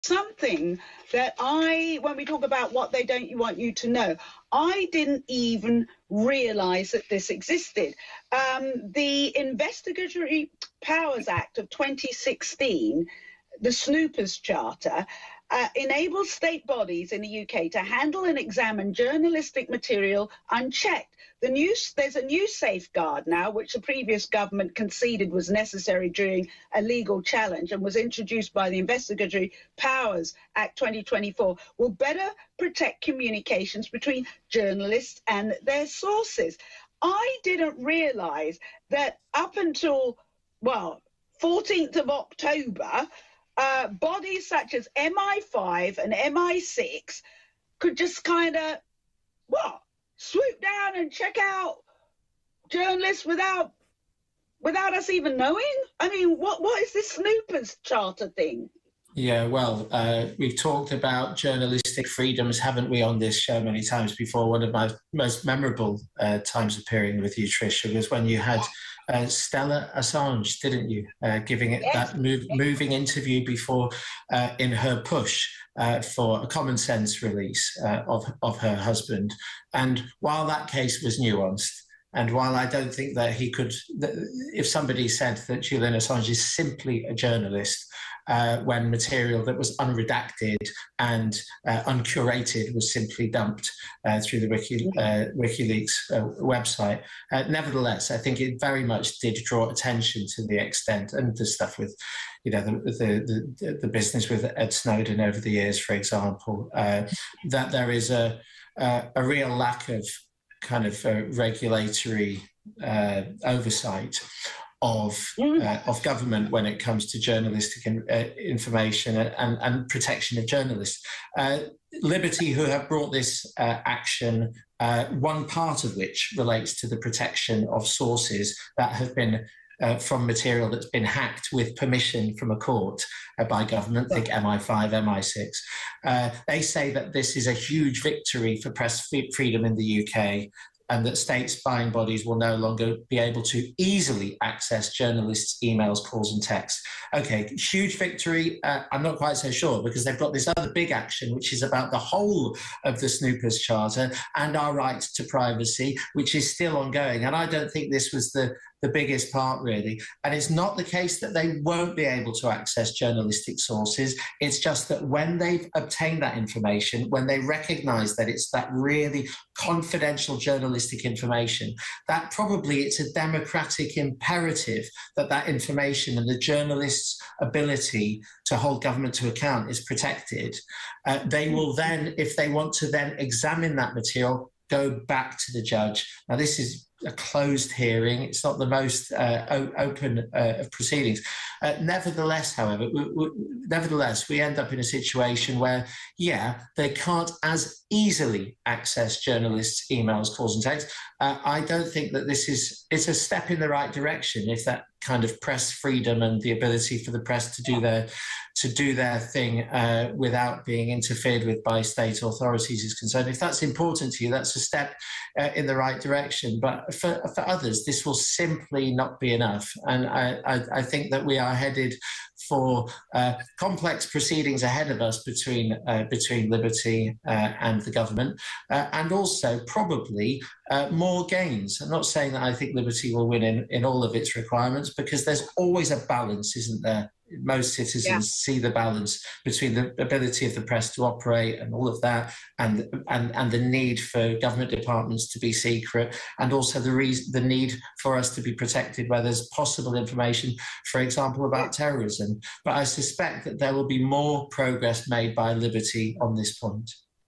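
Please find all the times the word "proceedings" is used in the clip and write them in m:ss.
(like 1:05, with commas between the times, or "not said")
3:10, 3:44.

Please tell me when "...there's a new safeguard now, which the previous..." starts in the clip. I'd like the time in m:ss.
0:21.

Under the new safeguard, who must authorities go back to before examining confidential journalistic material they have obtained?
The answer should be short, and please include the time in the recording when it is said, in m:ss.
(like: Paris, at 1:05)
the judge, at 3:05.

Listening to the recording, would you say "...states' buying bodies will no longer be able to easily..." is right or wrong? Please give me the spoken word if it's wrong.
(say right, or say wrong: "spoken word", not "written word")
right.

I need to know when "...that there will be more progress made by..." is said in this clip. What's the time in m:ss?
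4:13.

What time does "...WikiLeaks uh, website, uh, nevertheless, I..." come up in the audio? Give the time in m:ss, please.
1:35.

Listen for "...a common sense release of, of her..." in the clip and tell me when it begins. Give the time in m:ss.
1:16.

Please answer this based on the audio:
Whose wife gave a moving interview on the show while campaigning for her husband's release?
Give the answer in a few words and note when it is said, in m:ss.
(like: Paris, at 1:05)
Julian Assange, at 1:09.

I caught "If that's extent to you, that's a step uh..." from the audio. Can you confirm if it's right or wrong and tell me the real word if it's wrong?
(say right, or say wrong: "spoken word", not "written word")
wrong: "important", not "extent".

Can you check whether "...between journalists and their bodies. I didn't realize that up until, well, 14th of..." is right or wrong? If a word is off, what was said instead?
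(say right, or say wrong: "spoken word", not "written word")
wrong: "sources", not "bodies".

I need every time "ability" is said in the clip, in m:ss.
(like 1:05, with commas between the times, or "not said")
2:57, 3:26, 4:00.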